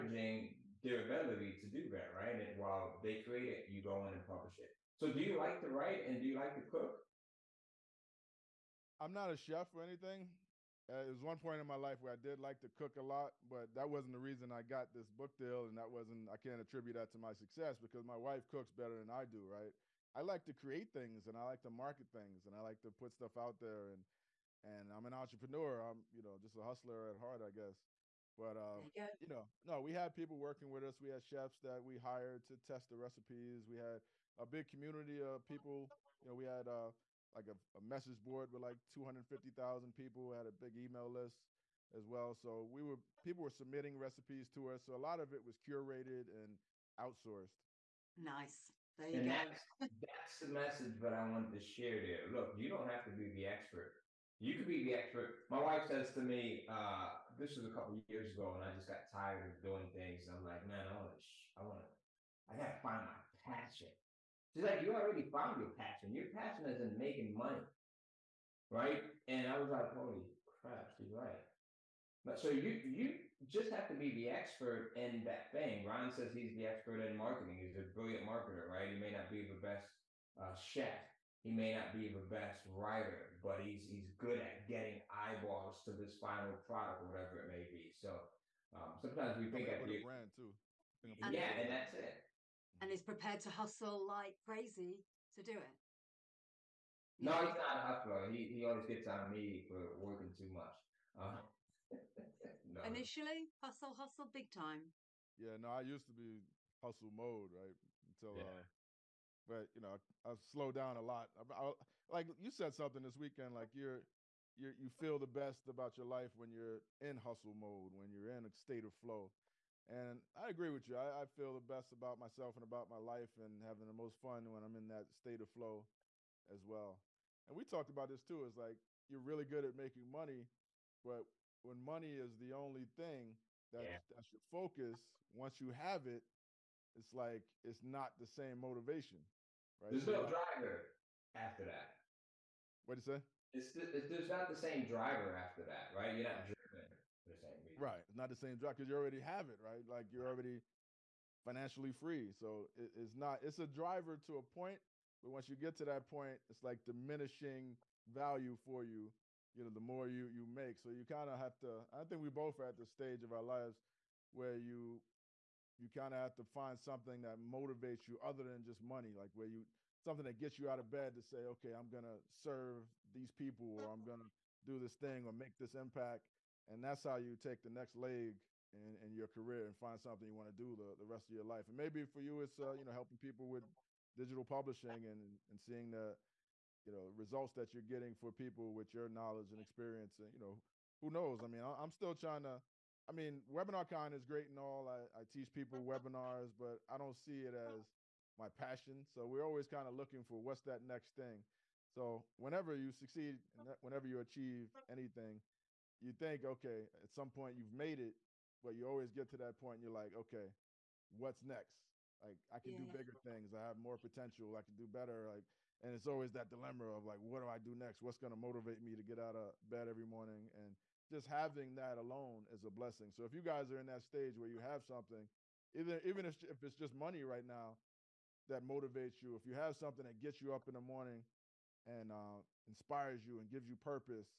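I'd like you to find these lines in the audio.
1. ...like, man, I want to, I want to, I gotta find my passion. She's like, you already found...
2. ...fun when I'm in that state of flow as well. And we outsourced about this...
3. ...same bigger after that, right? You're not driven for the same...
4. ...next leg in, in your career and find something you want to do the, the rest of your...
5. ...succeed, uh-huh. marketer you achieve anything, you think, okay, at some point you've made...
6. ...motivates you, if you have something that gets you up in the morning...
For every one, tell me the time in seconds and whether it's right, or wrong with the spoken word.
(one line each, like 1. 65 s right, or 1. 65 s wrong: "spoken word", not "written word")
1. 60 s right
2. 124 s wrong: "talked", not "outsourced"
3. 144 s wrong: "driver", not "bigger"
4. 177 s right
5. 202 s wrong: "whenever", not "marketer"
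6. 228 s right.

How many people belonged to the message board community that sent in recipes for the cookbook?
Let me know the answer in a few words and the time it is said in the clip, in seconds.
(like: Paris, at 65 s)
250,000, at 38 s.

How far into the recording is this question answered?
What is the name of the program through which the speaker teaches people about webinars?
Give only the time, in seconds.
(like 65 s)
193 s.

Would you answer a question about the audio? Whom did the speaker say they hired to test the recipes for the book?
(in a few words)
Chefs.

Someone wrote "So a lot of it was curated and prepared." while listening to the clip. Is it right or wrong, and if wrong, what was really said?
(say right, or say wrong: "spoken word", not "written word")
wrong: "outsourced", not "prepared".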